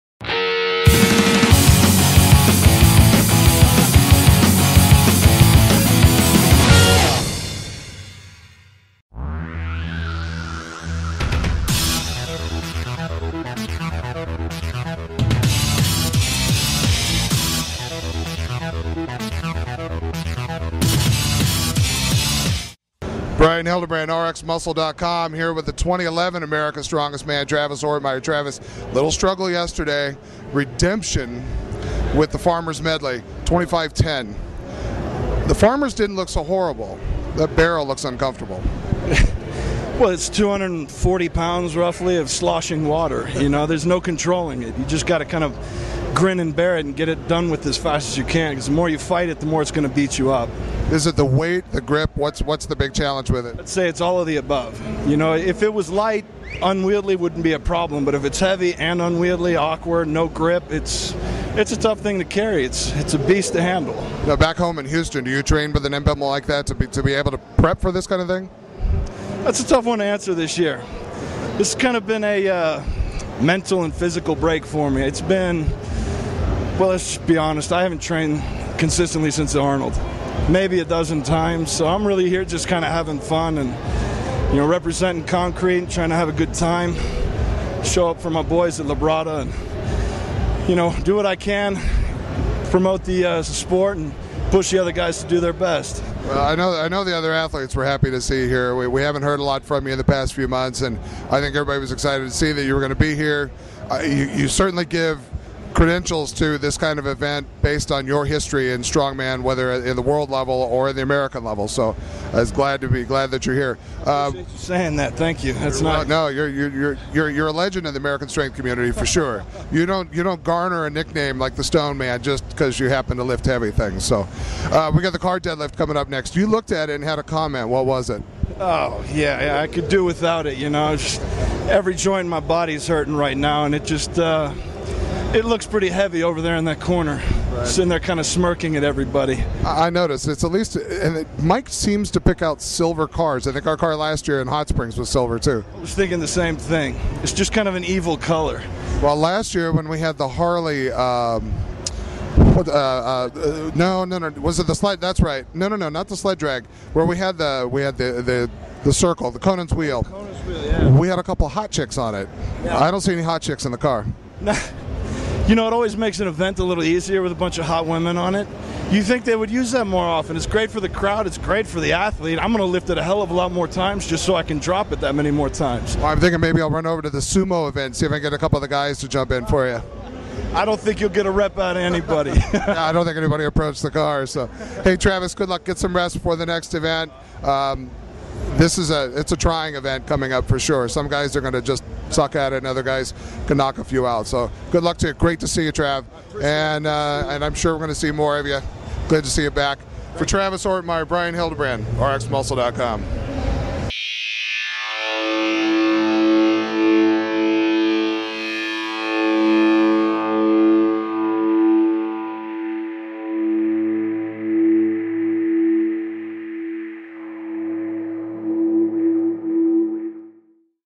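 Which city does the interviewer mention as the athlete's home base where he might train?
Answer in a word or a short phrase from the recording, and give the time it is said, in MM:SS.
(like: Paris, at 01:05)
Houston, at 01:04.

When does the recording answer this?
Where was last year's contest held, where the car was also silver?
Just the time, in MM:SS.
02:24.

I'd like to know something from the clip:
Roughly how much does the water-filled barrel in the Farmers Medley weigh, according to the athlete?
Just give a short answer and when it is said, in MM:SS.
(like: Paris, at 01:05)
240 pounds, at 00:40.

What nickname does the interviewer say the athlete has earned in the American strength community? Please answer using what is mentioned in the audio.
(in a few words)
the Stone Man.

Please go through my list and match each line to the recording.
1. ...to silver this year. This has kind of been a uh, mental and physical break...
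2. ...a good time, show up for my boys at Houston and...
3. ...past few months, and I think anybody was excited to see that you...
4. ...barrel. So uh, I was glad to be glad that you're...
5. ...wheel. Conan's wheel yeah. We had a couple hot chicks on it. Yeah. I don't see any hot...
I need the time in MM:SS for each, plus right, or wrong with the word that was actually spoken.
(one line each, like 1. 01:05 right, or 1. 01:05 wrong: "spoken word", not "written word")
1. 01:09 wrong: "answer", not "silver"
2. 01:26 wrong: "Labrada", not "Houston"
3. 01:40 wrong: "everybody", not "anybody"
4. 01:51 wrong: "level", not "barrel"
5. 02:39 right.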